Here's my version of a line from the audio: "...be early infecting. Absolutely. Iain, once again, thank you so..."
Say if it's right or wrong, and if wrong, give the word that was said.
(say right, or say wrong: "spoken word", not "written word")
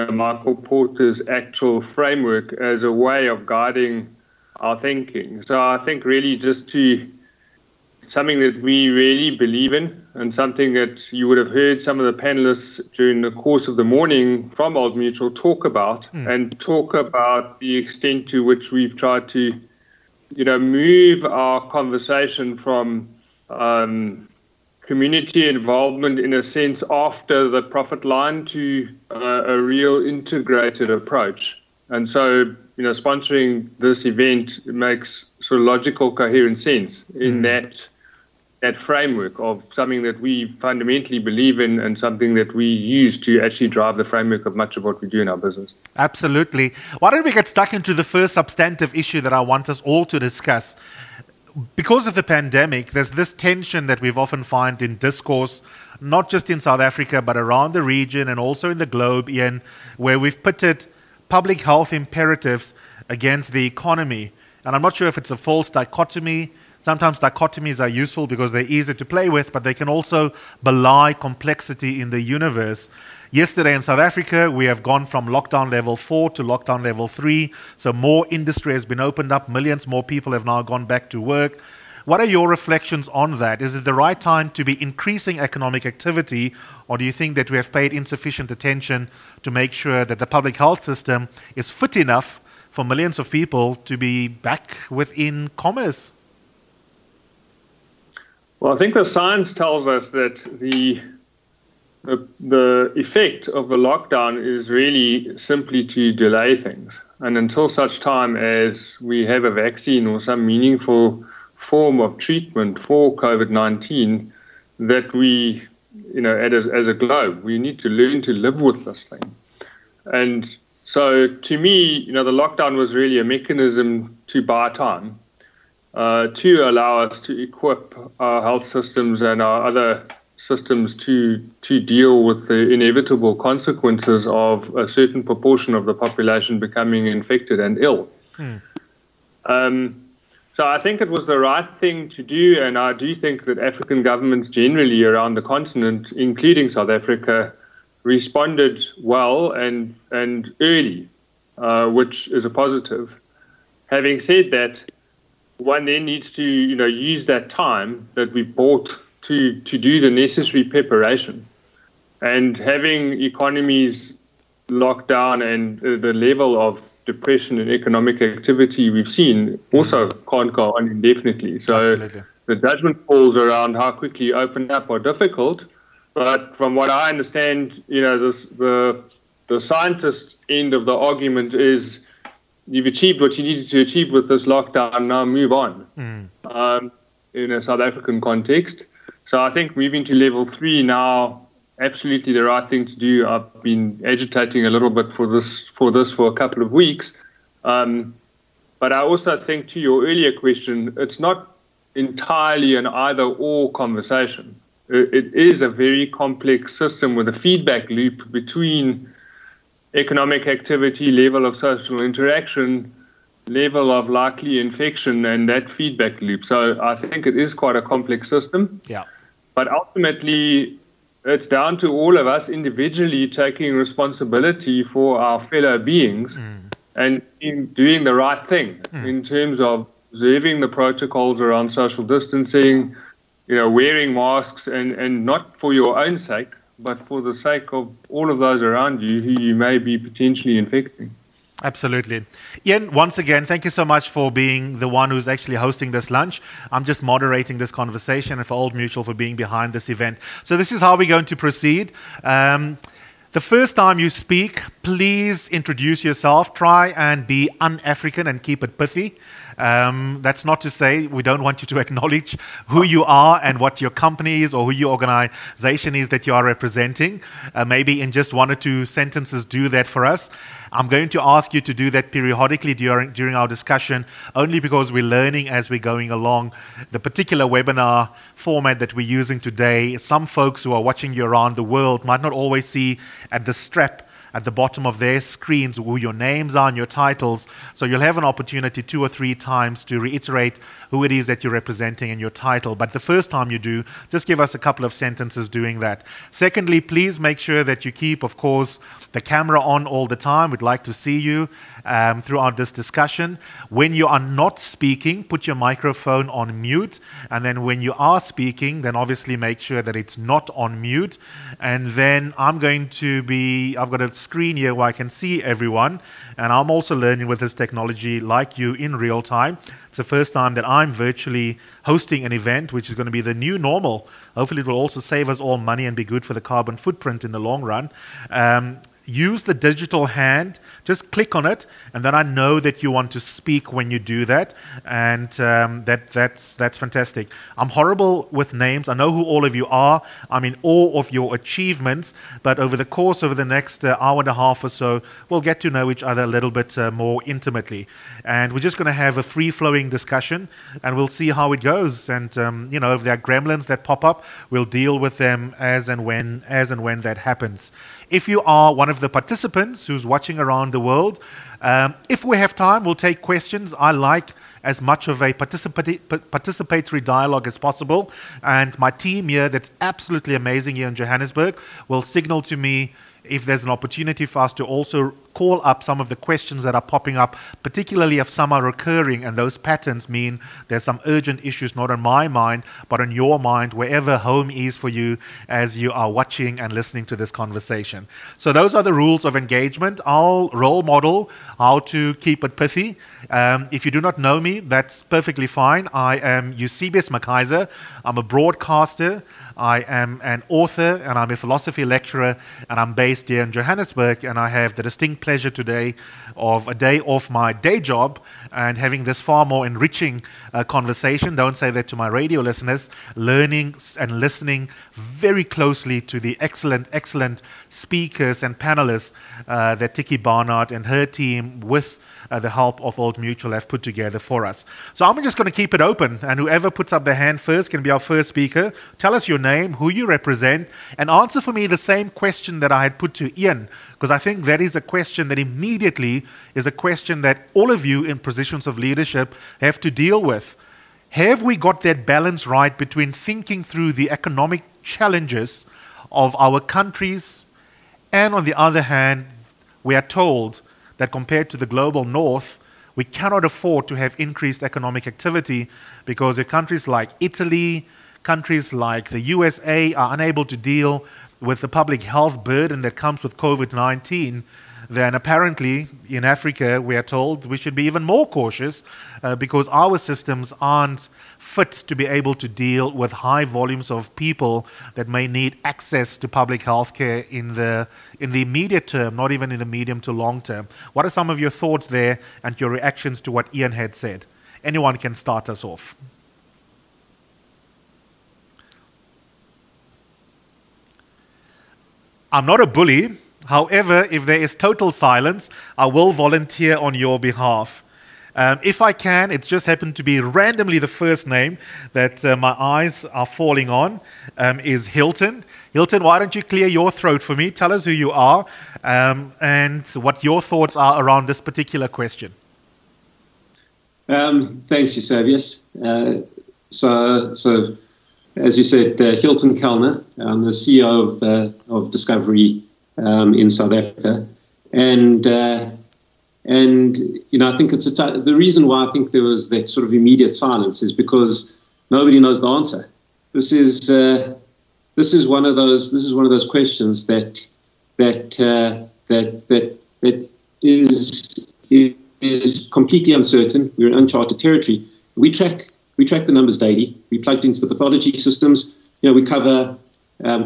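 wrong: "potentially", not "early".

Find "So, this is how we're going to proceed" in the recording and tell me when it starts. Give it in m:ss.
4:10.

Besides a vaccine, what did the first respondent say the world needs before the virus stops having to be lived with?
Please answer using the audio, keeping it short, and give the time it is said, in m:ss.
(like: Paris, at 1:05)
meaningful form of treatment, at 1:50.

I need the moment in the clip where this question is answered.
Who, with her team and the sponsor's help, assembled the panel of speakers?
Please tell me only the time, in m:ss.
6:59.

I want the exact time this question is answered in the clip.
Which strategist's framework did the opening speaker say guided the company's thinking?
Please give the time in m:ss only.
0:00.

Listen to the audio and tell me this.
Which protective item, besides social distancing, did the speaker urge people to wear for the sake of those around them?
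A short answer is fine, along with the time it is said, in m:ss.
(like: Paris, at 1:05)
masks, at 3:54.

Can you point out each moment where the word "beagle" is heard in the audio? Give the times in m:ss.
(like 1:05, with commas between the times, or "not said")
not said.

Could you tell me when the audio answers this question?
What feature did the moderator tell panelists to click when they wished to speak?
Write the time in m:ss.
5:29.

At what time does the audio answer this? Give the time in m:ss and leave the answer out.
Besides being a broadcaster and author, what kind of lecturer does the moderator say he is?
6:41.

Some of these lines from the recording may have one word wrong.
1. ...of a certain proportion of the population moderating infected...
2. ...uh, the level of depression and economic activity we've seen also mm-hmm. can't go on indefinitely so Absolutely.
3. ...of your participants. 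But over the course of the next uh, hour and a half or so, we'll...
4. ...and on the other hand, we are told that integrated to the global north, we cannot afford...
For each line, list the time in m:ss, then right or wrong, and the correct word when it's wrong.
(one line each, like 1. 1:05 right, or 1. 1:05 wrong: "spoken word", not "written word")
1. 2:14 wrong: "becoming", not "moderating"
2. 2:45 right
3. 5:40 wrong: "achievements", not "participants"
4. 7:28 wrong: "compared", not "integrated".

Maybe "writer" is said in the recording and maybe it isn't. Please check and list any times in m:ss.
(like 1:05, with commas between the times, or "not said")
not said.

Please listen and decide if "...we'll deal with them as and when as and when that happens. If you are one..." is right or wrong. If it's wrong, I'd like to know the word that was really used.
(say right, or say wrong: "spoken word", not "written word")
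right.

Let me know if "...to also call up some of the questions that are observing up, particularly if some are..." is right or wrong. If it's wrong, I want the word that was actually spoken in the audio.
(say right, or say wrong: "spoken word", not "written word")
wrong: "popping", not "observing".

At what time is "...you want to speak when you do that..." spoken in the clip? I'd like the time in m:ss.
5:32.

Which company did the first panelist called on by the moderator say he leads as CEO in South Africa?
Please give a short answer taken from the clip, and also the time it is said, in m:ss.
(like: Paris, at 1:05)
Discovery, at 8:41.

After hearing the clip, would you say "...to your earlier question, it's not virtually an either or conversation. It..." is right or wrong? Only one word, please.
wrong.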